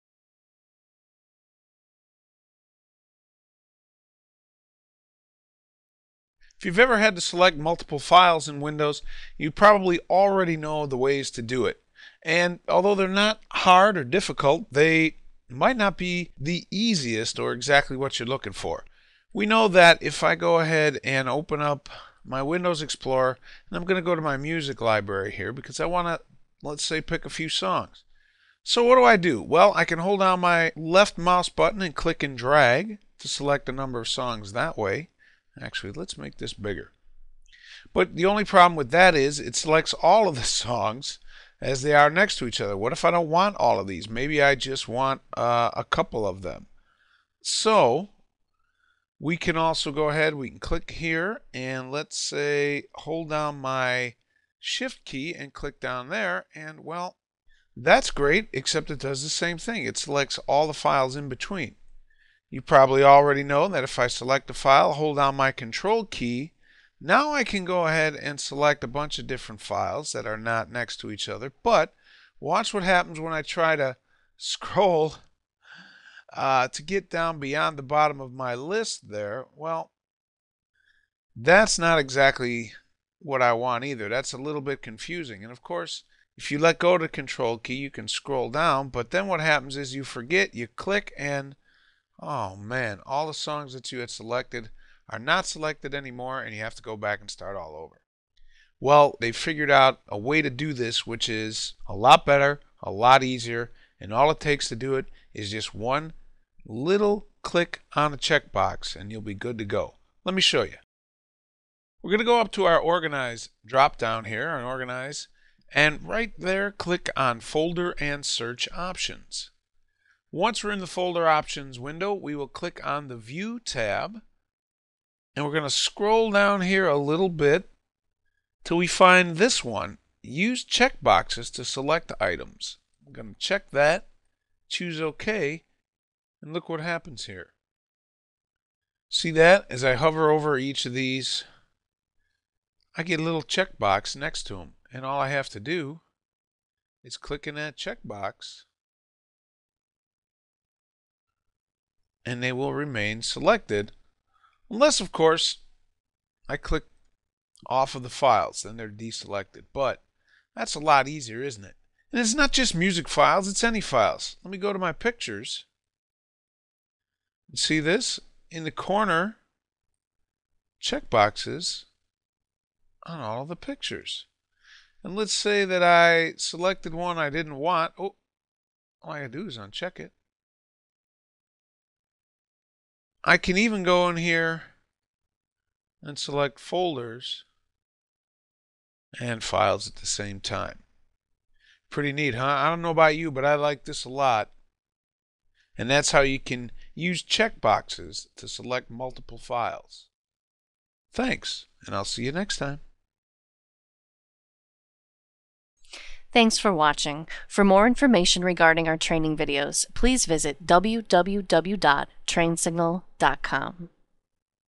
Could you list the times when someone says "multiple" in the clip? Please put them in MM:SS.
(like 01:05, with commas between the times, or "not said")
00:07, 03:18.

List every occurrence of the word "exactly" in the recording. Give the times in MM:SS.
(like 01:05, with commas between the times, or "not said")
00:17, 01:21.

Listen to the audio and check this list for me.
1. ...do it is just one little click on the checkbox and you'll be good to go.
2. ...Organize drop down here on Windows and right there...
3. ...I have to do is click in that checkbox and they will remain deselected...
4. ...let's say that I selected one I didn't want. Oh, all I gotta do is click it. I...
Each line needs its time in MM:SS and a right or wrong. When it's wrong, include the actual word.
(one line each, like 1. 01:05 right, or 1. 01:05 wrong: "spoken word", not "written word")
1. 01:44 right
2. 01:52 wrong: "Organize", not "Windows"
3. 02:25 wrong: "selected", not "deselected"
4. 02:55 wrong: "uncheck", not "click".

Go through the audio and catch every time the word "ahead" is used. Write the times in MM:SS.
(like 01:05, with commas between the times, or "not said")
00:20, 00:50, 01:07.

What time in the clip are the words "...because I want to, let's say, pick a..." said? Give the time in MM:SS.
00:25.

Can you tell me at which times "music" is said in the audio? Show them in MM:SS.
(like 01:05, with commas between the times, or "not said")
00:24, 02:42.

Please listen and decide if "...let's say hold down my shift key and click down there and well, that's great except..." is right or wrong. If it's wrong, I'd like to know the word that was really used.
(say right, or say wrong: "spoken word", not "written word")
right.